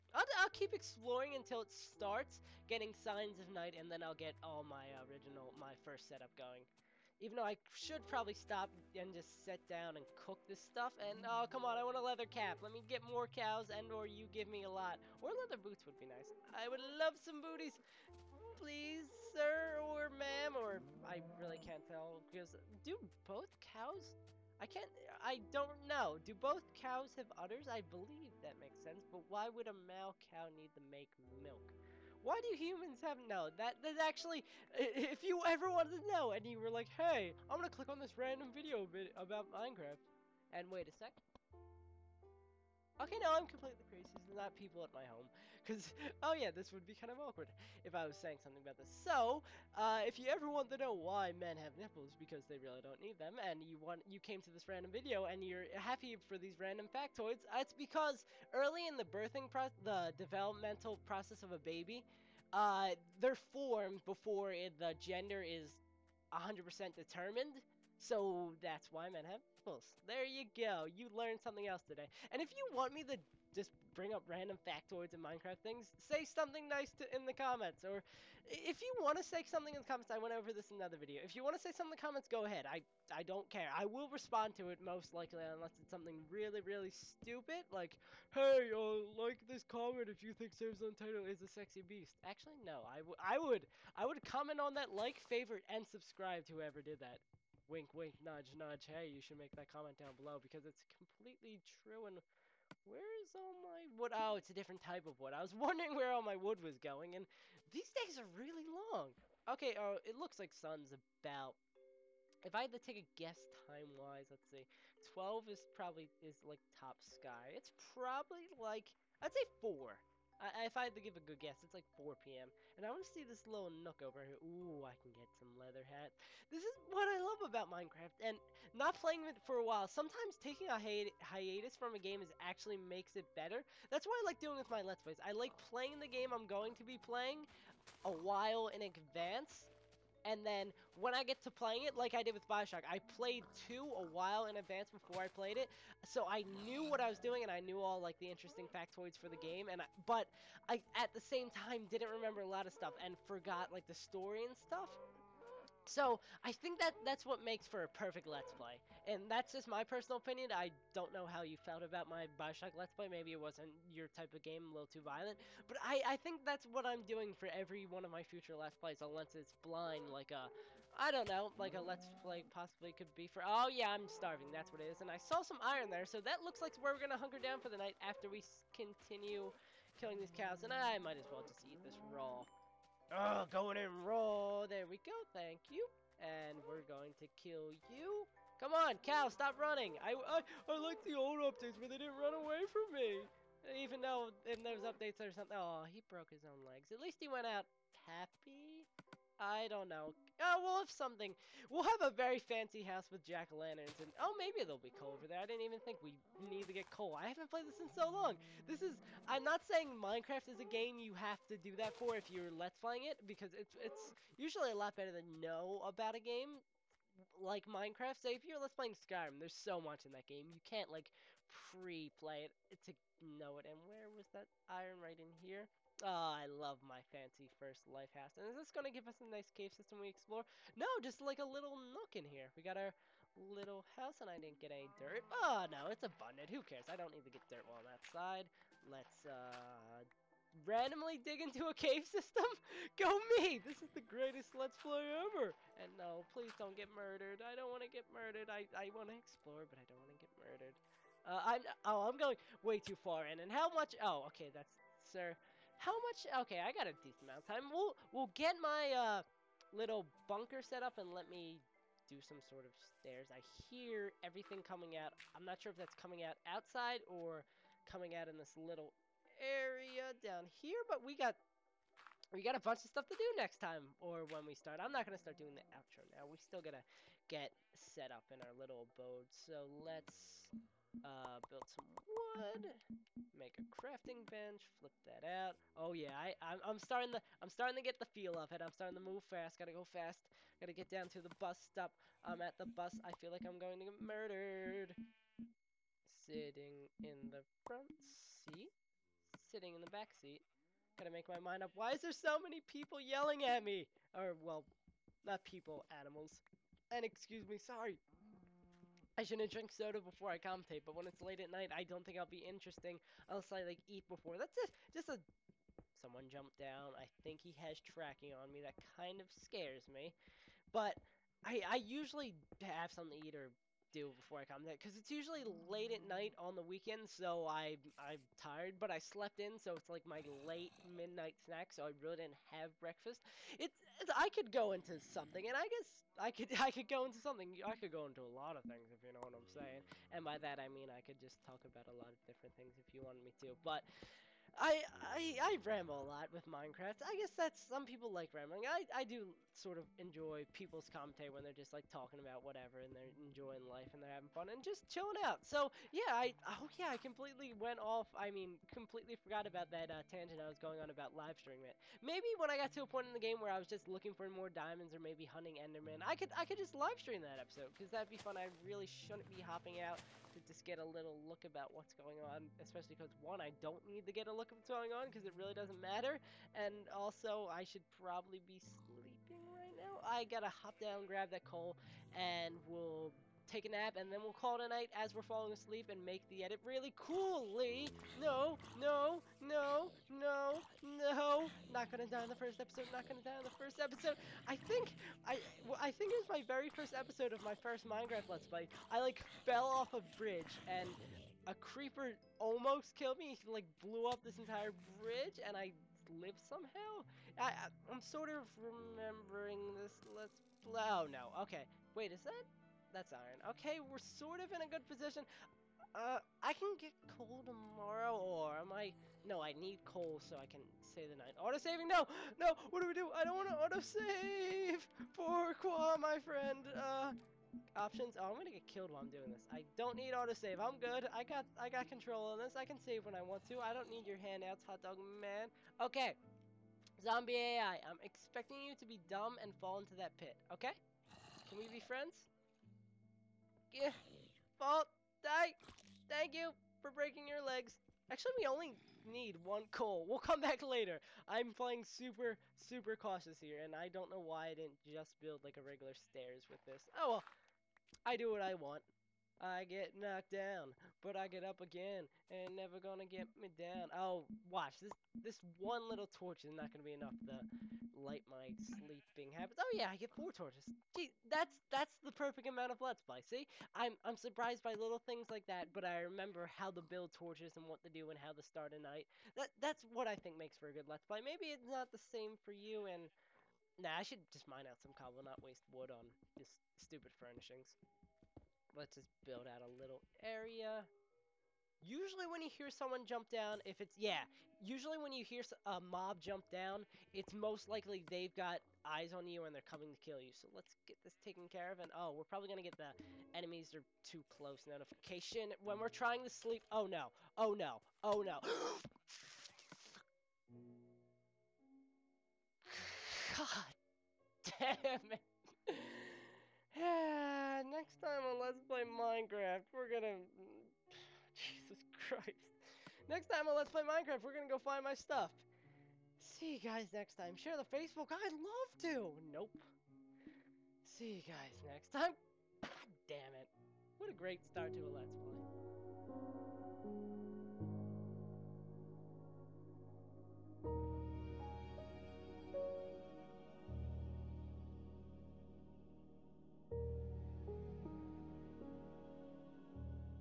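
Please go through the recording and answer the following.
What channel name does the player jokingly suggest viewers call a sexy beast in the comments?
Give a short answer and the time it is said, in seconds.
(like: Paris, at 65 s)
SaveAsUntitled, at 90 s.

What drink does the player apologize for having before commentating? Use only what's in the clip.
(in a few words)
Soda.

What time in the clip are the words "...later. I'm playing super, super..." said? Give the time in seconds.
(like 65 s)
450 s.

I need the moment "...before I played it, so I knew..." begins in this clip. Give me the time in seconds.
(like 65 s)
144 s.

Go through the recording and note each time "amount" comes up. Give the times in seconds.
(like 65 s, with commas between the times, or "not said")
257 s, 472 s.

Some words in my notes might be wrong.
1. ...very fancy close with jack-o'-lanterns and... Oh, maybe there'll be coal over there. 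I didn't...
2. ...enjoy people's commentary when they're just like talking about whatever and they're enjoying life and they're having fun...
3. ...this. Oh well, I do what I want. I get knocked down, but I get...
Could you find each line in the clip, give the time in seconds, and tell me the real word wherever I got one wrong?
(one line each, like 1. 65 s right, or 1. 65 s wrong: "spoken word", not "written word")
1. 202 s wrong: "house", not "close"
2. 349 s right
3. 456 s right.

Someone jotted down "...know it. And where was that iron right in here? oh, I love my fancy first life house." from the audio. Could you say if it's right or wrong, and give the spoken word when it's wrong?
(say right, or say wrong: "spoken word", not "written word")
right.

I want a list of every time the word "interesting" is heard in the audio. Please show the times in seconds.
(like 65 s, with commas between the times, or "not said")
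148 s, 312 s.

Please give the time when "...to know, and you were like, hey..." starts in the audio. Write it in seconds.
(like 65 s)
36 s.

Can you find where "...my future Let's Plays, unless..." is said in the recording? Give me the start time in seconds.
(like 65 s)
168 s.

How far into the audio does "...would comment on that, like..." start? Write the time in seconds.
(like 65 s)
94 s.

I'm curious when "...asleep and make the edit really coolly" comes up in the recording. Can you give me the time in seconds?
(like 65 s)
385 s.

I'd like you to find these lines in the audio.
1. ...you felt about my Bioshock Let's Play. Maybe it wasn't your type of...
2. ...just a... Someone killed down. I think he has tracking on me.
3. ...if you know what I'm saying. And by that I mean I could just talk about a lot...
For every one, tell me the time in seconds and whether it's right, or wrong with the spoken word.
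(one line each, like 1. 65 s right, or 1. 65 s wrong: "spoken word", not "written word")
1. 161 s right
2. 314 s wrong: "jumped", not "killed"
3. 338 s right.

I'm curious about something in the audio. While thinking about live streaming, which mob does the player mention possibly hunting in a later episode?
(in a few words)
Enderman.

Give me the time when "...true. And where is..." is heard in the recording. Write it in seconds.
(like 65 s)
101 s.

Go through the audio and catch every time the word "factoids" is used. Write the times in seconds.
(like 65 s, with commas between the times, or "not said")
56 s, 74 s, 148 s.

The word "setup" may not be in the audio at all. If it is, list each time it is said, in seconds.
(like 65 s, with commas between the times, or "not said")
6 s.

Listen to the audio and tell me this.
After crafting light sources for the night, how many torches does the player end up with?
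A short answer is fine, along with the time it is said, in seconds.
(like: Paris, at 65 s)
4, at 470 s.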